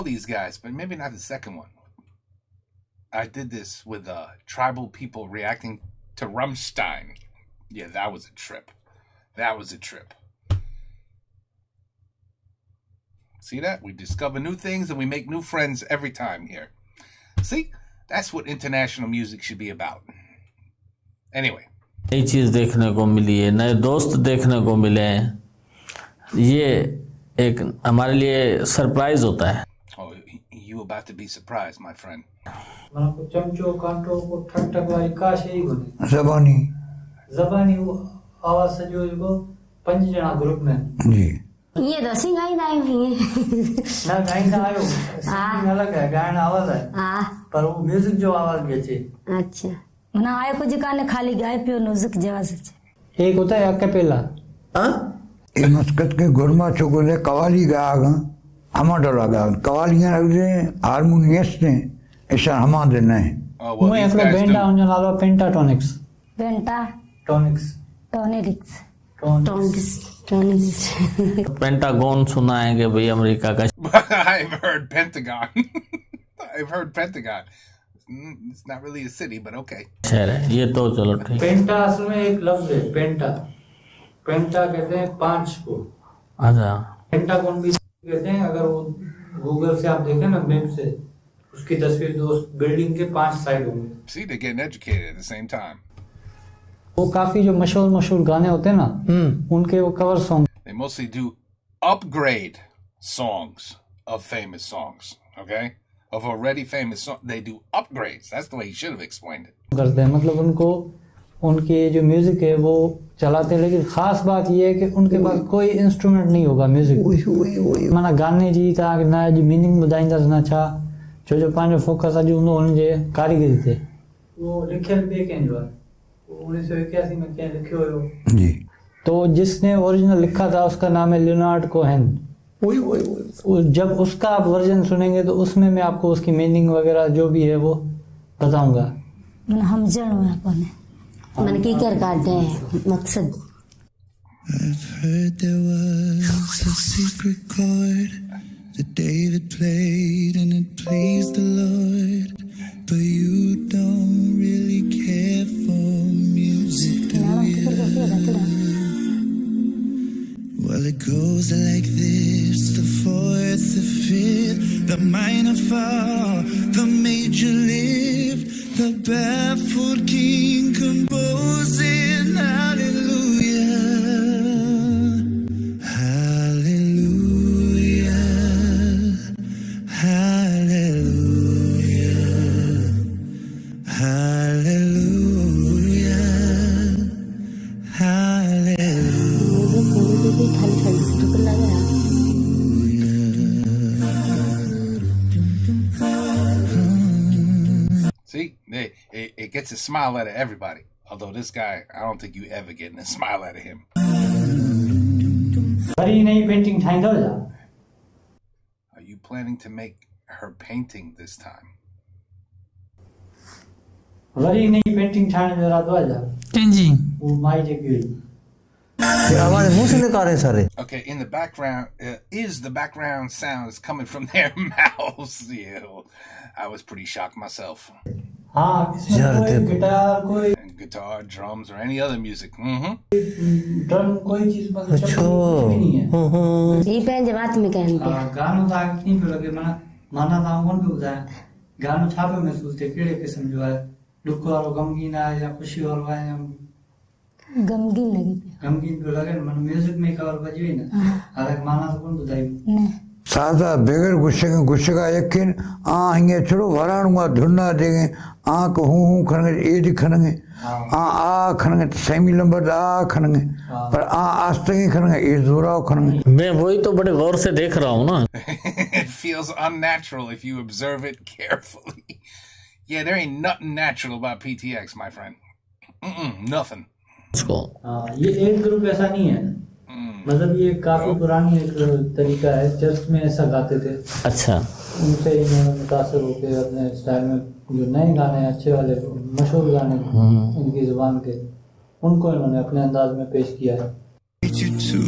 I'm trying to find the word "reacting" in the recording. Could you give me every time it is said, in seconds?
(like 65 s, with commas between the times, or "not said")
5 s.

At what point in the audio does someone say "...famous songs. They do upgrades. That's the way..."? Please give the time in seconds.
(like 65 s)
106 s.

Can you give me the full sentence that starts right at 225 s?
yeah, I was pretty shocked myself.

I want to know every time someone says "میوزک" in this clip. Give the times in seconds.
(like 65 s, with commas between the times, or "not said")
47 s, 112 s, 116 s, 232 s, 249 s.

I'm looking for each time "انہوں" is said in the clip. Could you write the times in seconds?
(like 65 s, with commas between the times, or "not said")
285 s, 292 s.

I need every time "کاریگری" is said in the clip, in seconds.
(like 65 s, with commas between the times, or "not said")
123 s.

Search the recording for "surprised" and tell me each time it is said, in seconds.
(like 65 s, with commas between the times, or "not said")
31 s.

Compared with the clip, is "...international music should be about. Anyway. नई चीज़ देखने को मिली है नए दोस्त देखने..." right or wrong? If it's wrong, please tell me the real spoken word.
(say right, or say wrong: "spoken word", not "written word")
right.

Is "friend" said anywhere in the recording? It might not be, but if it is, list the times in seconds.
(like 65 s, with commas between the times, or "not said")
15 s, 31 s, 275 s.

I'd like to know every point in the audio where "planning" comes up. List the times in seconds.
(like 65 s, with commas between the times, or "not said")
209 s.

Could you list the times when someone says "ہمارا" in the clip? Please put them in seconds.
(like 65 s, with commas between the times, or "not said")
58 s.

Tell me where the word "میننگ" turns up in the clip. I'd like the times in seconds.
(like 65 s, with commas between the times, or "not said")
119 s, 136 s.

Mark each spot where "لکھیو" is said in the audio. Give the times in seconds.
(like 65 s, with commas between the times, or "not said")
127 s.